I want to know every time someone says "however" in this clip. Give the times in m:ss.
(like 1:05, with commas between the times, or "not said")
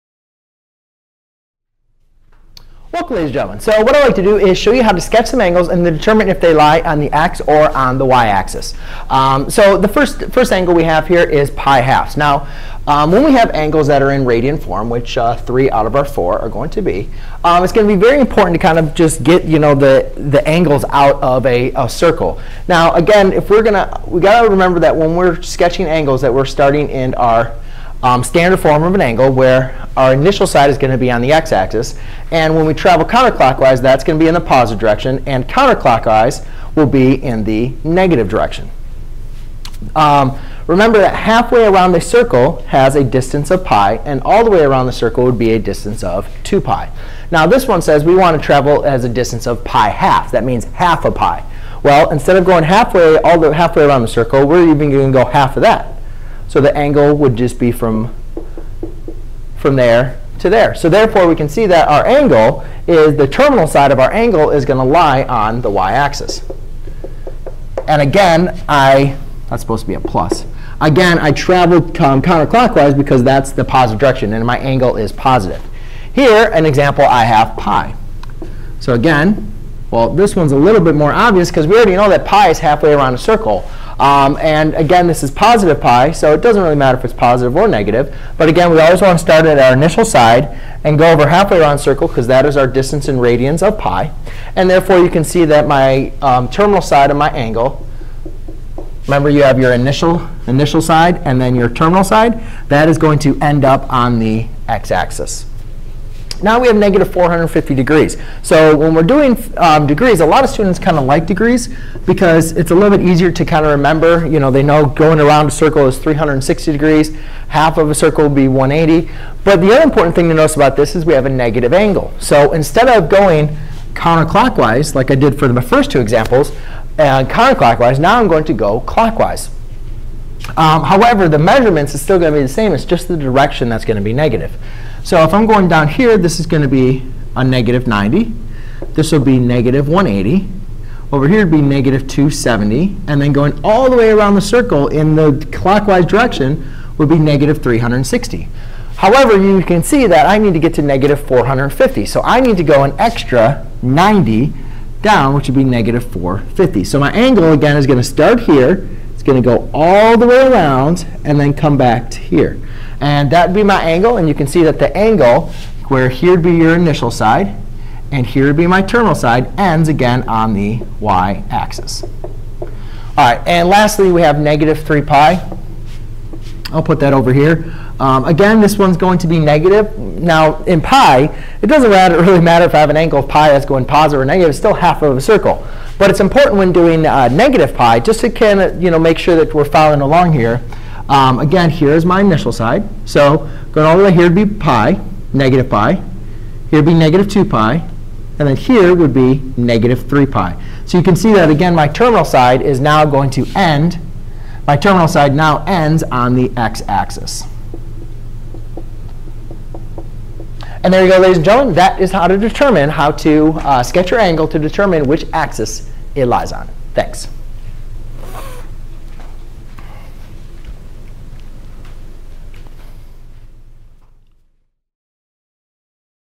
2:10, 2:28.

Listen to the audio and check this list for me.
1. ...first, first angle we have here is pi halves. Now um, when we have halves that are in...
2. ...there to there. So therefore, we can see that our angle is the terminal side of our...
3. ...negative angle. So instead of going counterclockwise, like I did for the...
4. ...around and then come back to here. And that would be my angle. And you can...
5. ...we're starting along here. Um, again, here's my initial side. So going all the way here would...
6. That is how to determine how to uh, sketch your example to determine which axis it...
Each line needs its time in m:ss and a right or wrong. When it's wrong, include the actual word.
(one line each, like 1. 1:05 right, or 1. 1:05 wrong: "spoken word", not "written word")
1. 0:09 wrong: "angles", not "halves"
2. 0:59 right
3. 2:01 right
4. 2:40 right
5. 3:09 wrong: "following", not "starting"
6. 3:31 wrong: "angle", not "example".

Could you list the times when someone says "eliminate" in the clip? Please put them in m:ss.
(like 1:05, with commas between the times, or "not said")
not said.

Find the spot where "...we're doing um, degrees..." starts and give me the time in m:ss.
1:48.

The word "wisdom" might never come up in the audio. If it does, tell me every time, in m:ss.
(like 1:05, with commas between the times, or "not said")
not said.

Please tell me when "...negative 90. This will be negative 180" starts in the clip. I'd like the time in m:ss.
2:17.